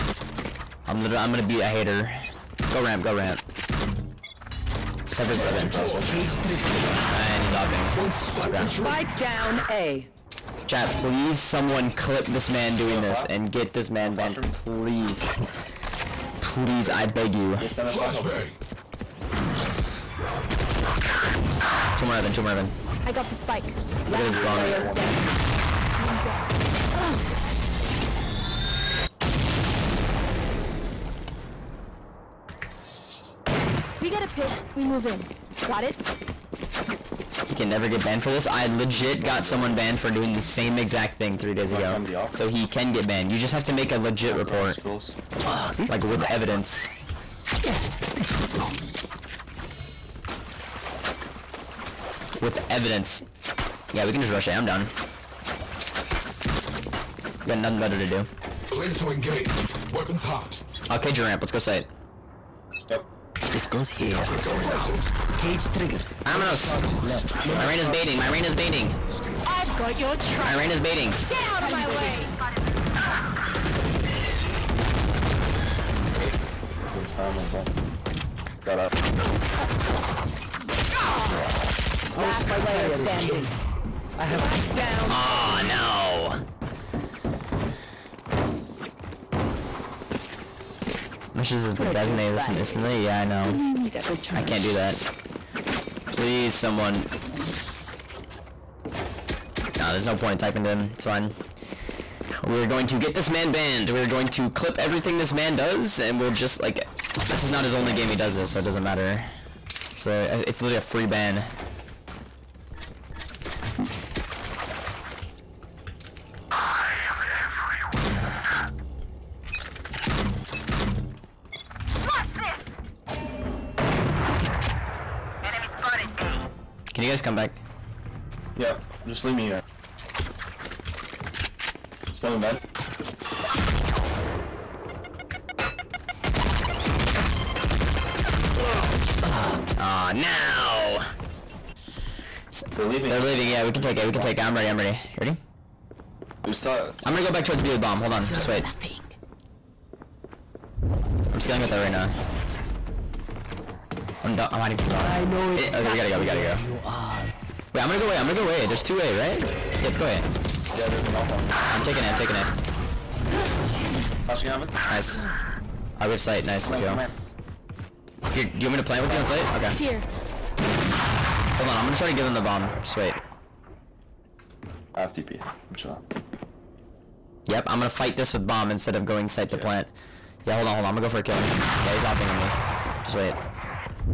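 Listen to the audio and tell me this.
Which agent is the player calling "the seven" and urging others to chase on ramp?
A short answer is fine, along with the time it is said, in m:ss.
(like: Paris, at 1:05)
Cypher, at 0:05.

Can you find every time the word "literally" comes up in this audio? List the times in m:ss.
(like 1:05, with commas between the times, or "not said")
0:01, 1:50.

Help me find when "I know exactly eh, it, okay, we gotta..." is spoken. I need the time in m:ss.
2:35.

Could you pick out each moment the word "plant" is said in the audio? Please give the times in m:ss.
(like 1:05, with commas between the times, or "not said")
2:48, 2:59.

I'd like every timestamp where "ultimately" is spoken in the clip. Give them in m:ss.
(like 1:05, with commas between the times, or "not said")
not said.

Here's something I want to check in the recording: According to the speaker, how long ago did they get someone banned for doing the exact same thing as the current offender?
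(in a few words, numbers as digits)
3 days ago.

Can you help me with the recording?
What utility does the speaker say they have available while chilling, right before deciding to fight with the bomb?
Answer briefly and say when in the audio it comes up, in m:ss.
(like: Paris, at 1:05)
TP, at 2:55.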